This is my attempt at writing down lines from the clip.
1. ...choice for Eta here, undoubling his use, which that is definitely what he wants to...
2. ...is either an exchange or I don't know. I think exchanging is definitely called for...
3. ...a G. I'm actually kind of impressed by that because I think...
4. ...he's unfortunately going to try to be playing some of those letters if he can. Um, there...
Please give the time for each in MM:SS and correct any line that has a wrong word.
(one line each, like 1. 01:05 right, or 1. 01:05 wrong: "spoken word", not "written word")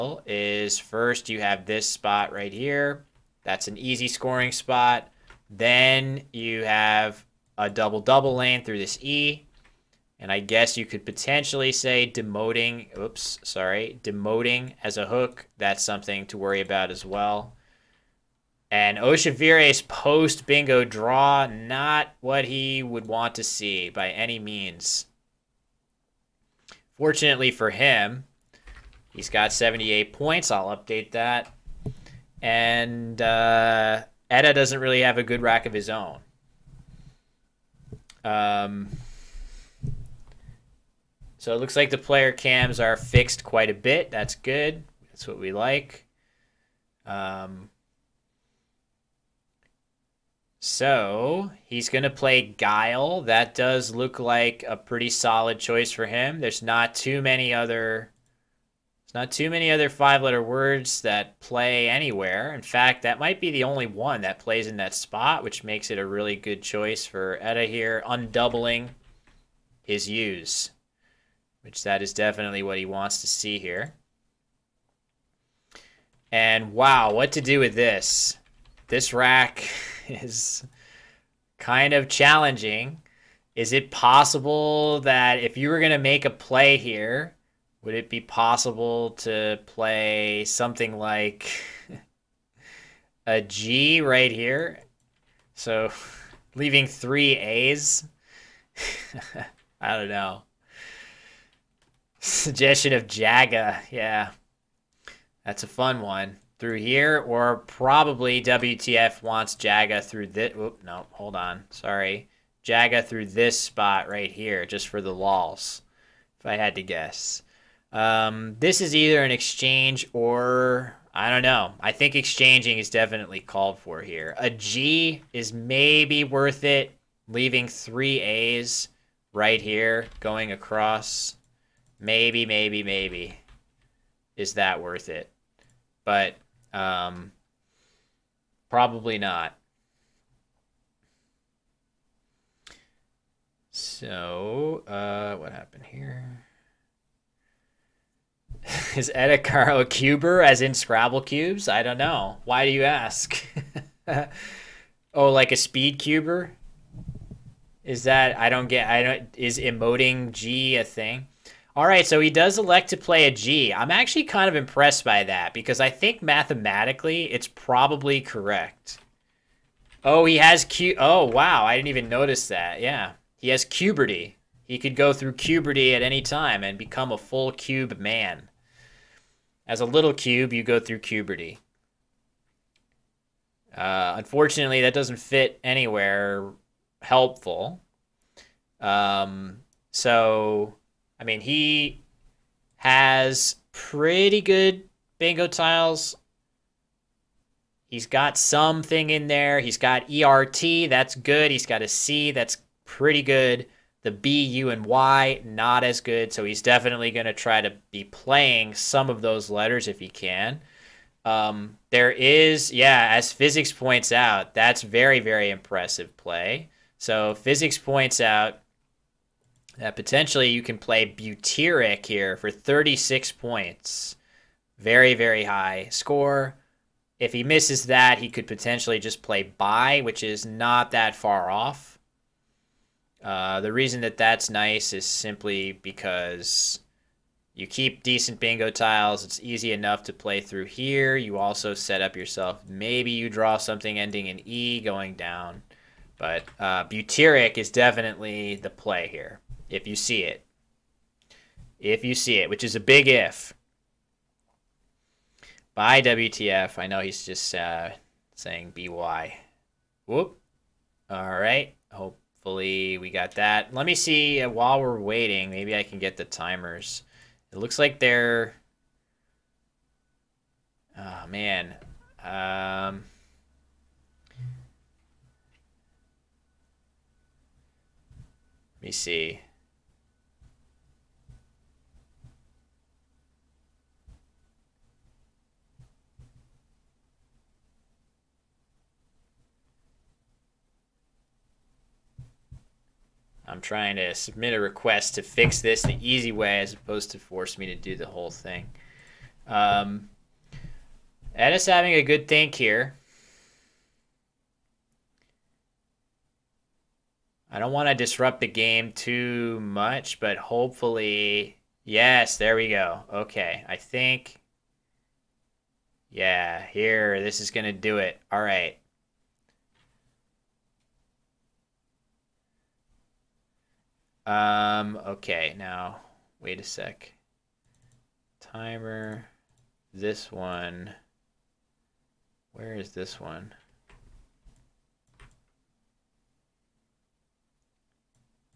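1. 01:06 right
2. 01:58 right
3. 02:43 right
4. 03:26 wrong: "definitely", not "unfortunately".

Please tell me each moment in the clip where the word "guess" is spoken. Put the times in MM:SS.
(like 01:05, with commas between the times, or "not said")
00:10, 01:56.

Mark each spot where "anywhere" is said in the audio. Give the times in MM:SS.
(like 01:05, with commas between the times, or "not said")
01:01, 03:05.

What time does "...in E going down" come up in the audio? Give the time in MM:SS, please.
04:04.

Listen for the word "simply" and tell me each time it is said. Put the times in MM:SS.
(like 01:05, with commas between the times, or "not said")
03:55.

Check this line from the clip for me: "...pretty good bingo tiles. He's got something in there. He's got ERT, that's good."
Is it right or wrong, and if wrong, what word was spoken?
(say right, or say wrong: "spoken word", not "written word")
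right.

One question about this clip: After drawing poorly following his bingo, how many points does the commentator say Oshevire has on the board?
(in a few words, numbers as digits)
78.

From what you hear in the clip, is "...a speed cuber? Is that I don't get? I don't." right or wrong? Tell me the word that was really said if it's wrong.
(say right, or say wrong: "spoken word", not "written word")
right.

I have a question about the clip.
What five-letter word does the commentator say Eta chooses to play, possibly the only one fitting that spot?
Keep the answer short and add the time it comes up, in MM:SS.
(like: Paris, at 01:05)
Guile, at 00:52.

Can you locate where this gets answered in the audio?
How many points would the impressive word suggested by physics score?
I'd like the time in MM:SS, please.
03:42.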